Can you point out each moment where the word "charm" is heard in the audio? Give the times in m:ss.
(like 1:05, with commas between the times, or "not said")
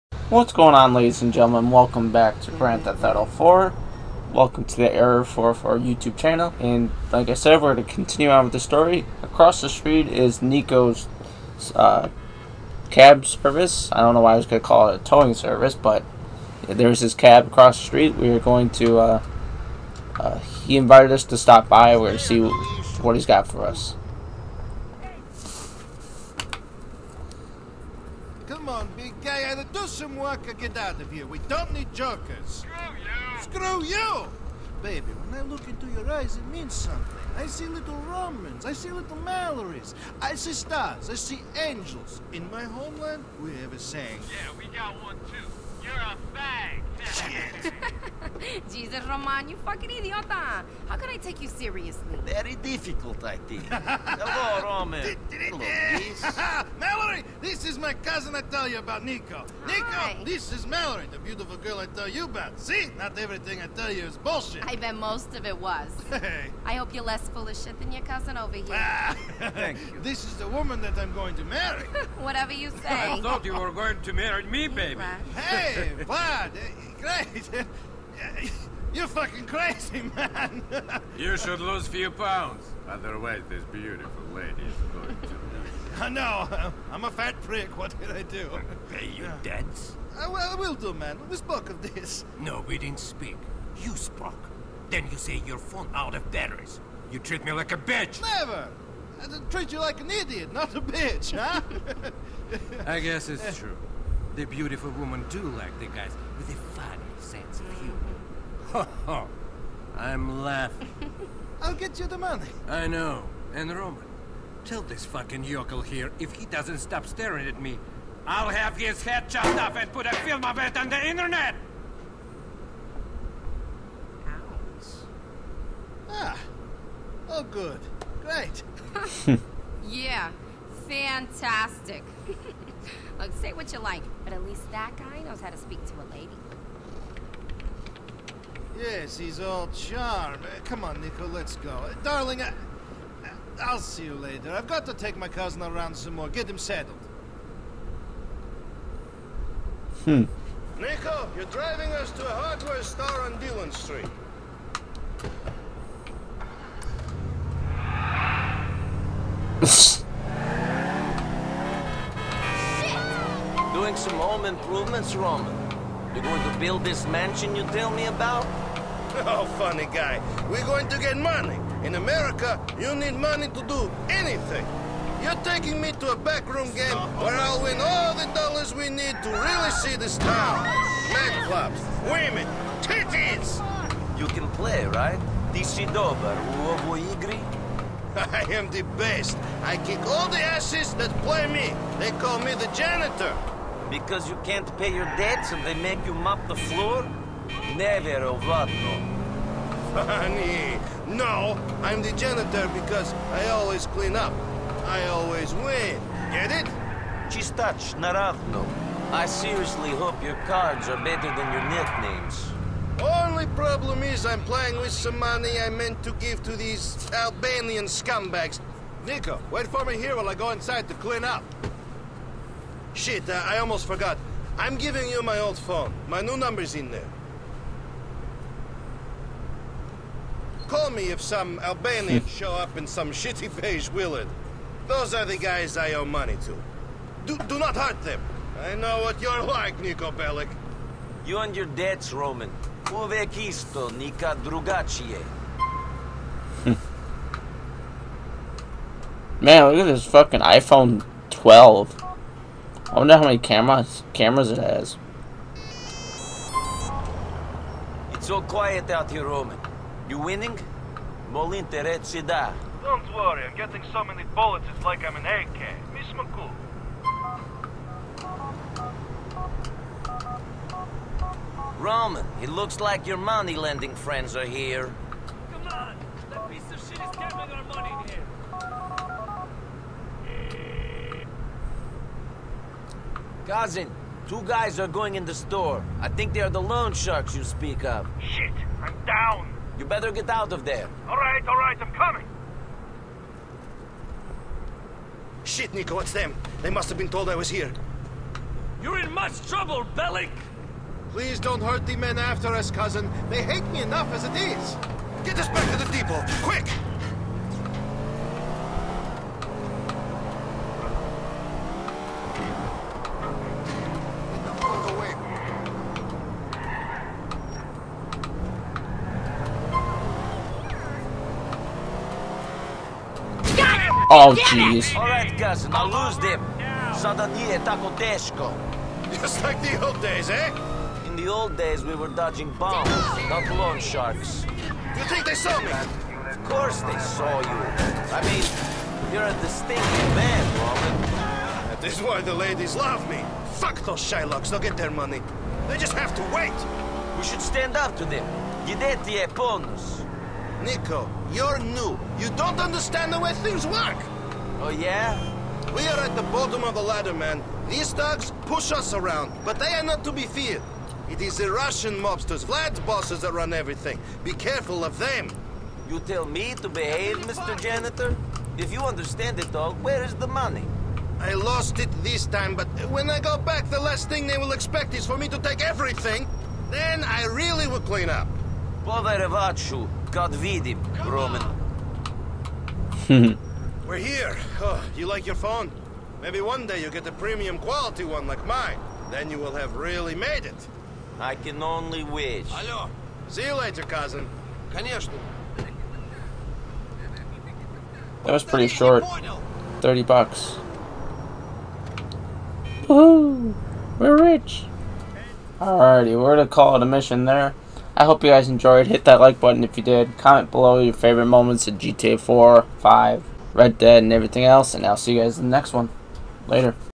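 2:19.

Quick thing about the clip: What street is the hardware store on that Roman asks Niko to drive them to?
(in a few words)
Dillon Street.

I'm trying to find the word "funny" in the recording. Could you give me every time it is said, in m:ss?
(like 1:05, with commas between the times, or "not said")
1:46, 2:49, 3:19.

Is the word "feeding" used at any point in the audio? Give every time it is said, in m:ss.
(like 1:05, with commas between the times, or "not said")
not said.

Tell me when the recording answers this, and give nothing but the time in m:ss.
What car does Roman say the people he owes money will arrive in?
3:53.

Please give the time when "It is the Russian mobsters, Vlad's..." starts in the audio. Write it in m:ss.
6:01.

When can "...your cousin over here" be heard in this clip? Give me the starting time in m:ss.
1:07.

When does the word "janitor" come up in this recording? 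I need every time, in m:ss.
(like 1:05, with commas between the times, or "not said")
3:12, 3:22, 6:07.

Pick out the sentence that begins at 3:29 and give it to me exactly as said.
I seriously hope your cards are better than your nicknames.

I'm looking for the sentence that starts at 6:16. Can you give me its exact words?
Then I really will clean up.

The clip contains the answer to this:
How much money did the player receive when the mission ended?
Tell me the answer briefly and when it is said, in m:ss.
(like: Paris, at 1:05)
$30, at 6:39.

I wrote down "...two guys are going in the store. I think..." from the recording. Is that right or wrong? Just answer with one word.
right.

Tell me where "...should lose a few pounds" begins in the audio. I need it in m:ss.
1:21.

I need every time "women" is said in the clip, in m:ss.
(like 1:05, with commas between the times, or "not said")
1:44, 3:02.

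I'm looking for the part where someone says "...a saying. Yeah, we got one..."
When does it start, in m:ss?
0:43.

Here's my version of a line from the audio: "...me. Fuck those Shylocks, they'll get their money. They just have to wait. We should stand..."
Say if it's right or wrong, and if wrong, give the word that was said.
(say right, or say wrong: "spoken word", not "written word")
right.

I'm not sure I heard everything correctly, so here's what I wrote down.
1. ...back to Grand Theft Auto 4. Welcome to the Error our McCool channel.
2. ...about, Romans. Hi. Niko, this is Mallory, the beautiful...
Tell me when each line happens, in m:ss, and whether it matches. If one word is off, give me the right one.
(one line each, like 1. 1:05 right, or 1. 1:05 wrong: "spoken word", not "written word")
1. 0:02 wrong: "YouTube", not "McCool"
2. 0:58 wrong: "Niko", not "Romans".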